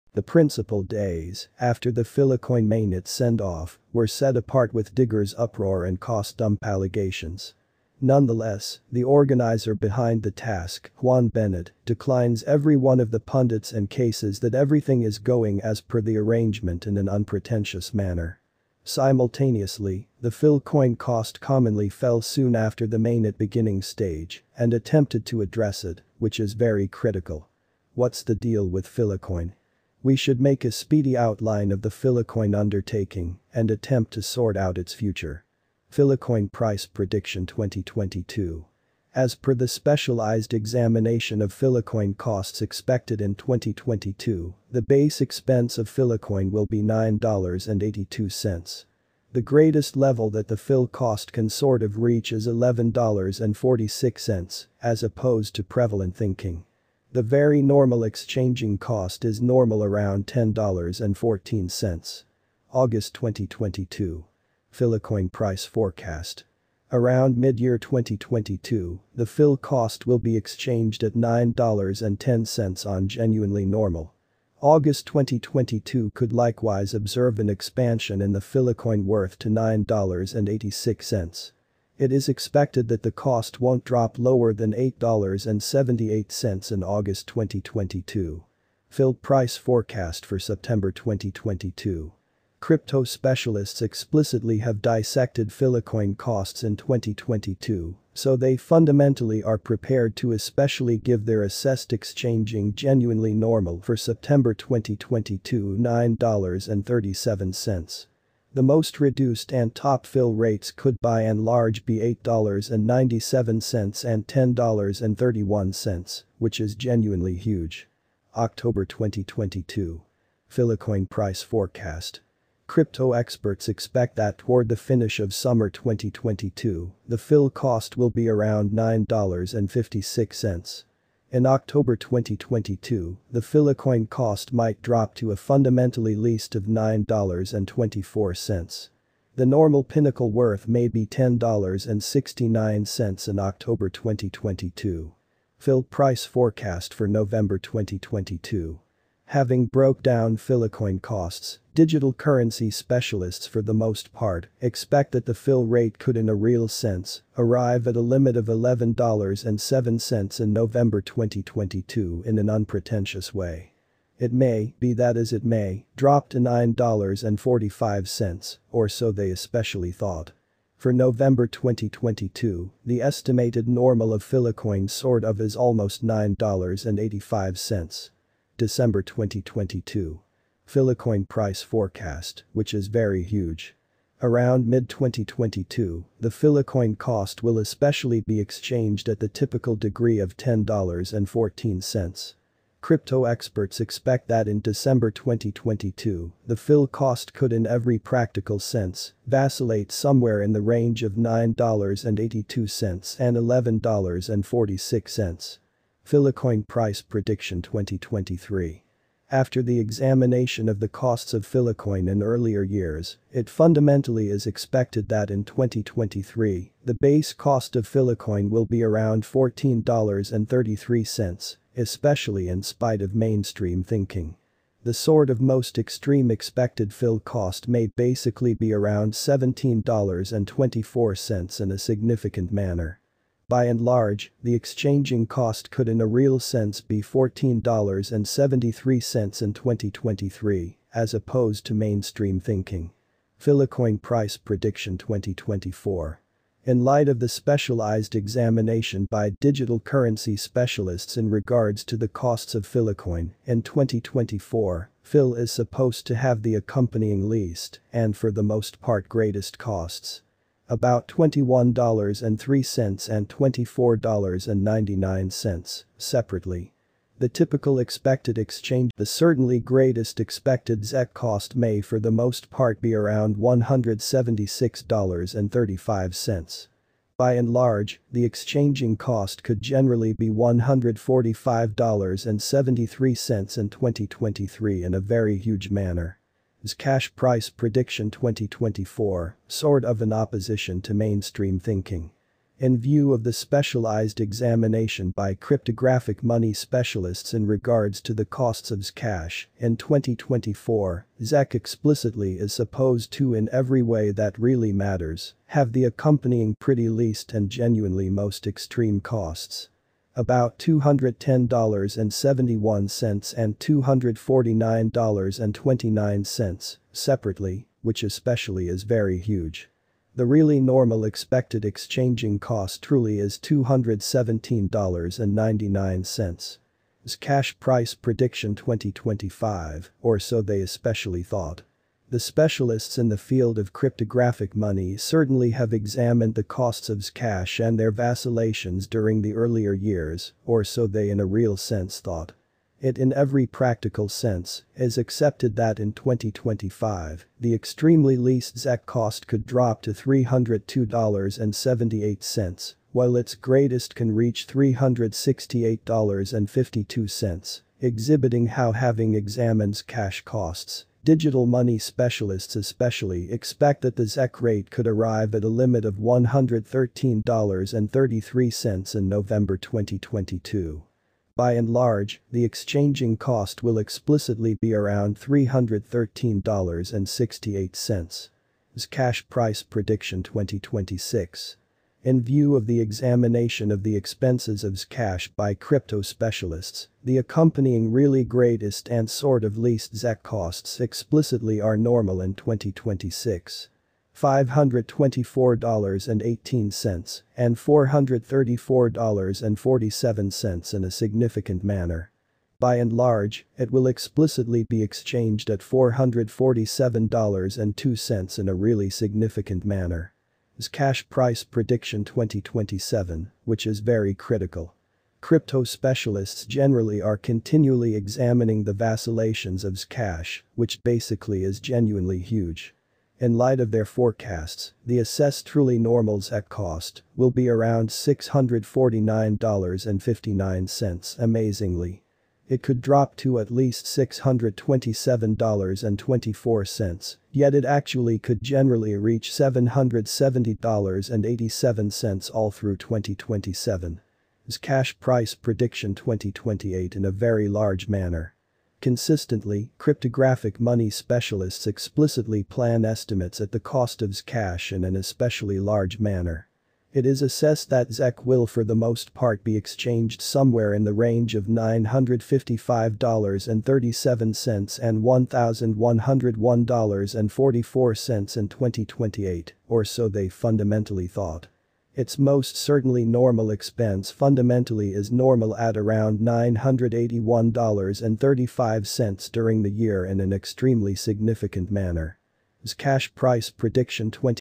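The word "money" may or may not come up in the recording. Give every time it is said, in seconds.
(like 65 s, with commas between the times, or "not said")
296 s, 334 s, 361 s, 450 s.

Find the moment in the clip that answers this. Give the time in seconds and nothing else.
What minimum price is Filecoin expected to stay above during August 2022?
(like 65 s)
84 s.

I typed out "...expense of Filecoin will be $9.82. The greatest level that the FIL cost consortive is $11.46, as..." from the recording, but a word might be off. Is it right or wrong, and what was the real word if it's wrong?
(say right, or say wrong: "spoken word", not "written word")
right.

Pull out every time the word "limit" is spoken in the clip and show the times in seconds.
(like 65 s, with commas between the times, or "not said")
158 s, 365 s.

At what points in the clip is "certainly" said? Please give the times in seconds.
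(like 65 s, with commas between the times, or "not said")
334 s, 472 s.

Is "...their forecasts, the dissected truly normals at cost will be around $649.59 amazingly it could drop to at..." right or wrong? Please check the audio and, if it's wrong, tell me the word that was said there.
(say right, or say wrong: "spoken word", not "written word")
wrong: "assessed", not "dissected".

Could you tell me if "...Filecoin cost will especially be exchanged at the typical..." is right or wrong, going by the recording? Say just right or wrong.
right.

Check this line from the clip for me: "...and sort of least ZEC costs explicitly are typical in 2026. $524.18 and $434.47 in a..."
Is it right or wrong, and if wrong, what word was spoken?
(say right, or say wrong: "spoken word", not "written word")
wrong: "normal", not "typical".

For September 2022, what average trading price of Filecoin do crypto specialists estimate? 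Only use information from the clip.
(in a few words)
$9.37.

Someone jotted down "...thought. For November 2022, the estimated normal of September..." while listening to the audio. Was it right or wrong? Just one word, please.
wrong.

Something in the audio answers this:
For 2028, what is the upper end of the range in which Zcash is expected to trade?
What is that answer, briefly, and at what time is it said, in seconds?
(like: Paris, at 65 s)
$1,101.44, at 465 s.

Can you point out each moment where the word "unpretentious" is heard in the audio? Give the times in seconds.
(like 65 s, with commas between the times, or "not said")
17 s, 162 s.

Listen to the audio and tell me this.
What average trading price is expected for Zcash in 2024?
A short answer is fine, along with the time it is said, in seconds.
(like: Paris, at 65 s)
$217.99, at 323 s.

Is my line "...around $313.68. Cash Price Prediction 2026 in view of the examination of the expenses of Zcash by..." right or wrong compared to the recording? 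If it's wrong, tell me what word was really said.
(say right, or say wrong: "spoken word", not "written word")
right.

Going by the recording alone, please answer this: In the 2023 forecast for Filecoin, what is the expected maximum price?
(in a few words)
$17.24.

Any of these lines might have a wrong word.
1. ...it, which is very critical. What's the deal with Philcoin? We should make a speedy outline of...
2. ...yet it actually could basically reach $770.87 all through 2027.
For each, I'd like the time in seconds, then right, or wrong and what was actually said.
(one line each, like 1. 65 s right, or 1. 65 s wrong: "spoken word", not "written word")
1. 25 s right
2. 437 s wrong: "generally", not "basically".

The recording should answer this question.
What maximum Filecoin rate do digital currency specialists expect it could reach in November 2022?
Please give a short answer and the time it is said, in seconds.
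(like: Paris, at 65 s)
$11.07, at 158 s.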